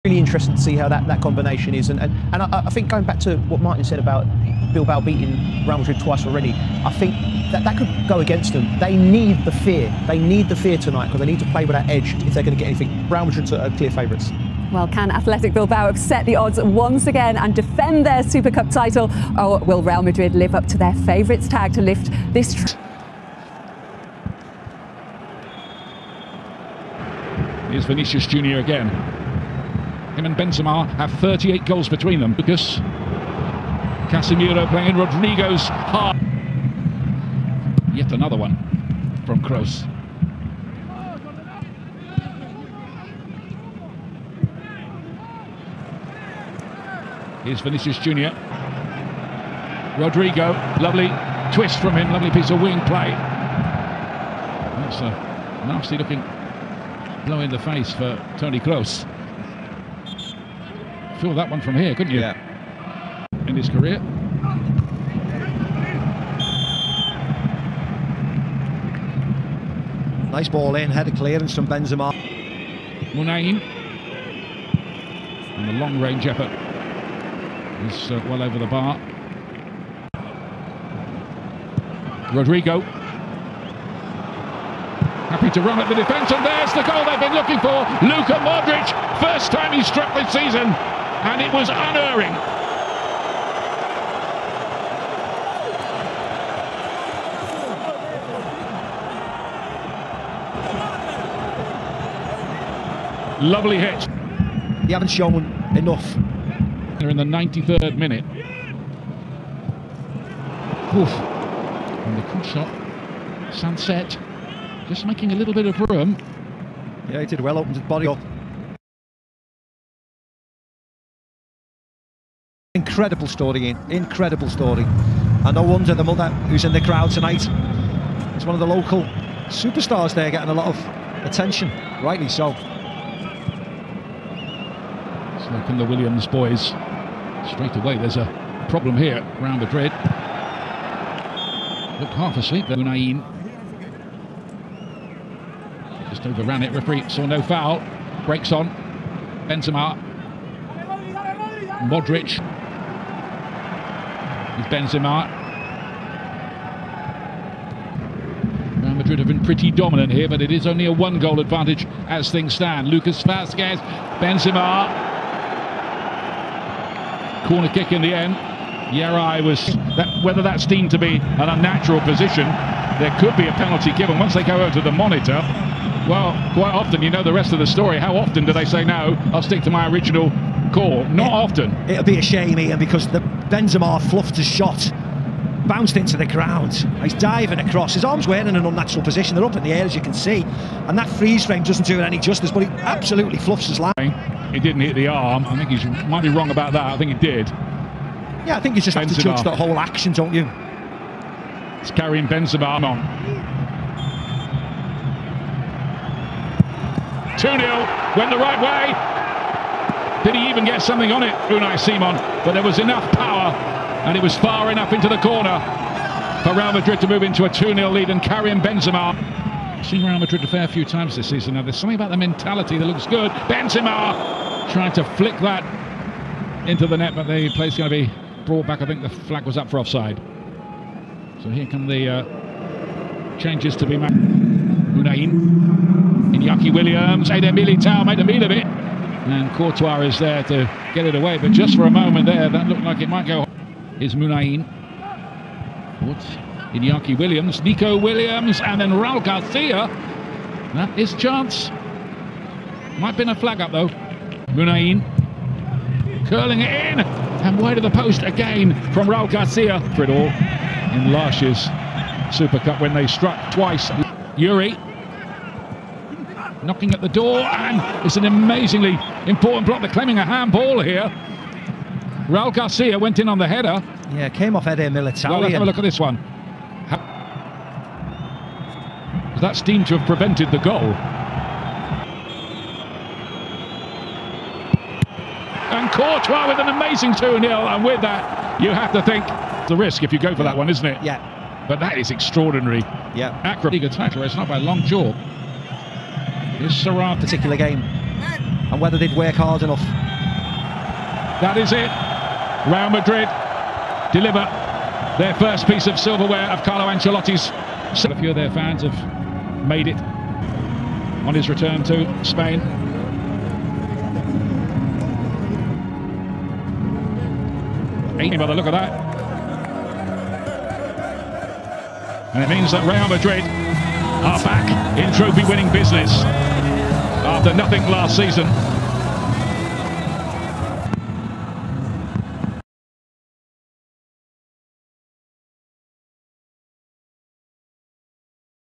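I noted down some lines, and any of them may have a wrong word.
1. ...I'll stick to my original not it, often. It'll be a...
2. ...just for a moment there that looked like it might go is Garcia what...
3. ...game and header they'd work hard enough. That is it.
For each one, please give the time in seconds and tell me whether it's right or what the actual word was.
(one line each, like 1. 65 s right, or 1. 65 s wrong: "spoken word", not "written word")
1. 179 s right
2. 241 s wrong: "Muniain", not "Garcia"
3. 297 s wrong: "whether", not "header".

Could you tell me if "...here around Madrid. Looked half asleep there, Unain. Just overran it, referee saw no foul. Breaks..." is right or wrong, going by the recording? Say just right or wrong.
right.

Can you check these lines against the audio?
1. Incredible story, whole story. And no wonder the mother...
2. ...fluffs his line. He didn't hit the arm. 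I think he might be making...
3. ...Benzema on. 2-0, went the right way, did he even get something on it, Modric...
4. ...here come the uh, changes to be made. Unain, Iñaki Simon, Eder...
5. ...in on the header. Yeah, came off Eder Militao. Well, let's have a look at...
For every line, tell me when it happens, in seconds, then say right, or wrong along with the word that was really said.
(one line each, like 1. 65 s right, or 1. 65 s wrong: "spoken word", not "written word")
1. 122 s wrong: "incredible", not "whole"
2. 193 s wrong: "wrong", not "making"
3. 202 s wrong: "Unai", not "Modric"
4. 231 s wrong: "Williams", not "Simon"
5. 273 s right.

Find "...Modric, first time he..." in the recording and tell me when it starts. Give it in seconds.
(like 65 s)
88 s.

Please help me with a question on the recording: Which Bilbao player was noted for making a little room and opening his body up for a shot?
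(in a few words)
Sancet.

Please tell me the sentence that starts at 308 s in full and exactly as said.
A few of their fans have made it on his return to Spain.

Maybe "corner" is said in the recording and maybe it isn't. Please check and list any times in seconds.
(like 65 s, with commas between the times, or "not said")
167 s, 215 s.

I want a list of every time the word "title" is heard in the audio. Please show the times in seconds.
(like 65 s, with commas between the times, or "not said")
18 s, 293 s.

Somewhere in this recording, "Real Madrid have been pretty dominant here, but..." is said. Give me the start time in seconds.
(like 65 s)
158 s.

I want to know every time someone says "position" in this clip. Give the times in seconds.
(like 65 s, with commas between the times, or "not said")
172 s, 189 s.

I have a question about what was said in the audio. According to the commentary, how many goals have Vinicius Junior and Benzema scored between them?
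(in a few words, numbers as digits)
38.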